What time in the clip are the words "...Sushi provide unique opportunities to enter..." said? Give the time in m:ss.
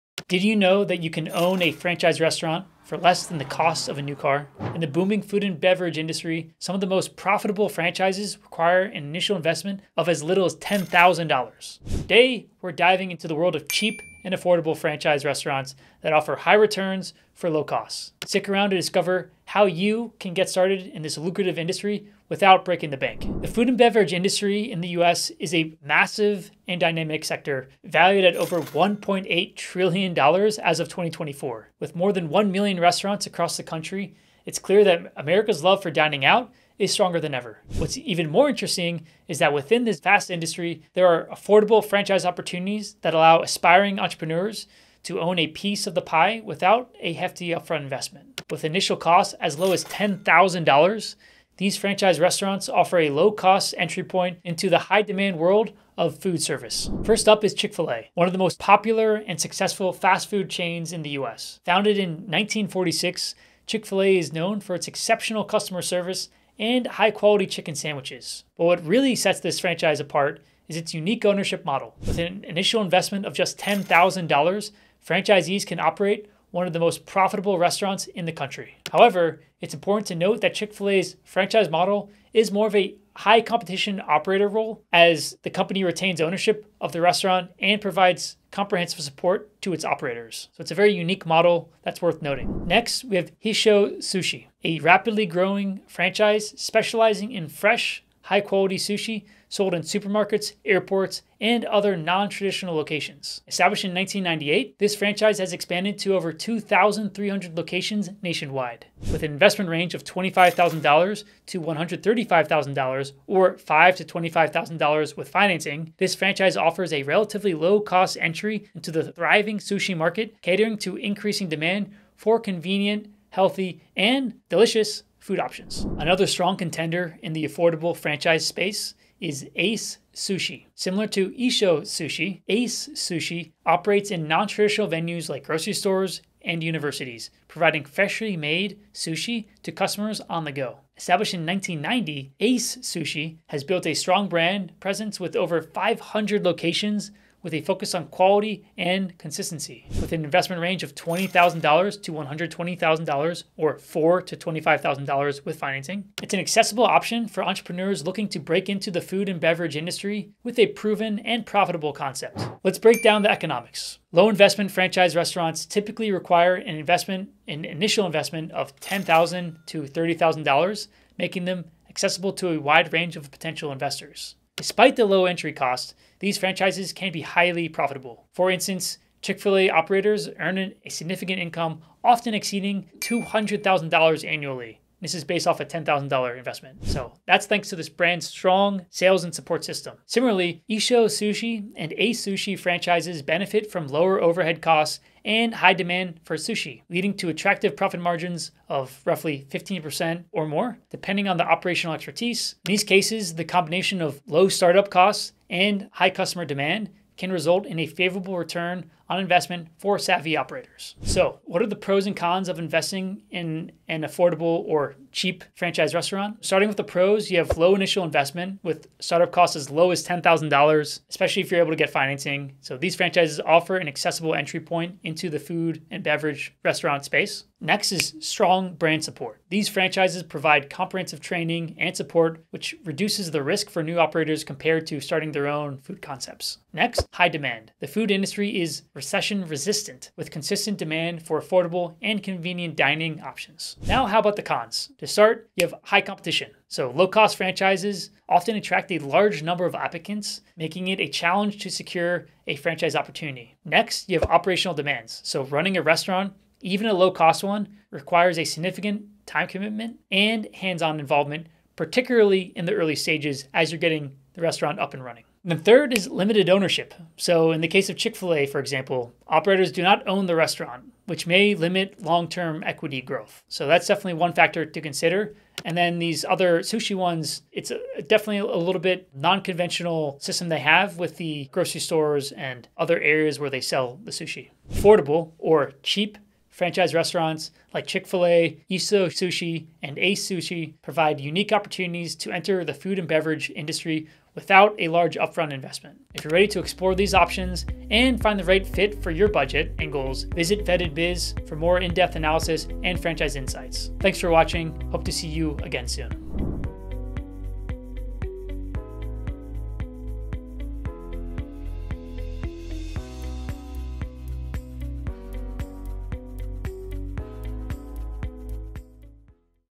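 4:50.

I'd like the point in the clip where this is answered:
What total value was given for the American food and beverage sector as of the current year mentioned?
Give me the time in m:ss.
0:28.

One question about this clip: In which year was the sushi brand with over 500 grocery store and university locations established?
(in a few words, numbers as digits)
1990.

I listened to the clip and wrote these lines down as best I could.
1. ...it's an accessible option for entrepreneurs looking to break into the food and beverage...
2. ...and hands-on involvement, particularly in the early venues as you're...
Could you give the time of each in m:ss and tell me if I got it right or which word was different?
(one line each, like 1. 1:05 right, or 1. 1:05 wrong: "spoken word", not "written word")
1. 2:36 right
2. 4:20 wrong: "stages", not "venues".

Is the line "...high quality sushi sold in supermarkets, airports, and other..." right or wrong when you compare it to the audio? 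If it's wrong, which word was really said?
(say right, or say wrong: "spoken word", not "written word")
right.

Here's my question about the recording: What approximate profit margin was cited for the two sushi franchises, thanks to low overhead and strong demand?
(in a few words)
15%.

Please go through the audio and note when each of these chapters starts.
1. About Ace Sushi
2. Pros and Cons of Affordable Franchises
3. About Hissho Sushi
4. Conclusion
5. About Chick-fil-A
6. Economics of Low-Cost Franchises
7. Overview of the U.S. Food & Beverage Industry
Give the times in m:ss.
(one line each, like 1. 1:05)
1. 2:06
2. 3:31
3. 1:33
4. 4:45
5. 0:57
6. 2:43
7. 0:24.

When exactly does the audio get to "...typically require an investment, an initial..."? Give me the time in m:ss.
2:45.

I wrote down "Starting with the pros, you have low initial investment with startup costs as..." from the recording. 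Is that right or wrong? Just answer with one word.
right.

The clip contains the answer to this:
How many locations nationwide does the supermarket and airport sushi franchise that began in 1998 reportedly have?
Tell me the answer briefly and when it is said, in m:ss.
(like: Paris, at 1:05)
over 2,300, at 1:46.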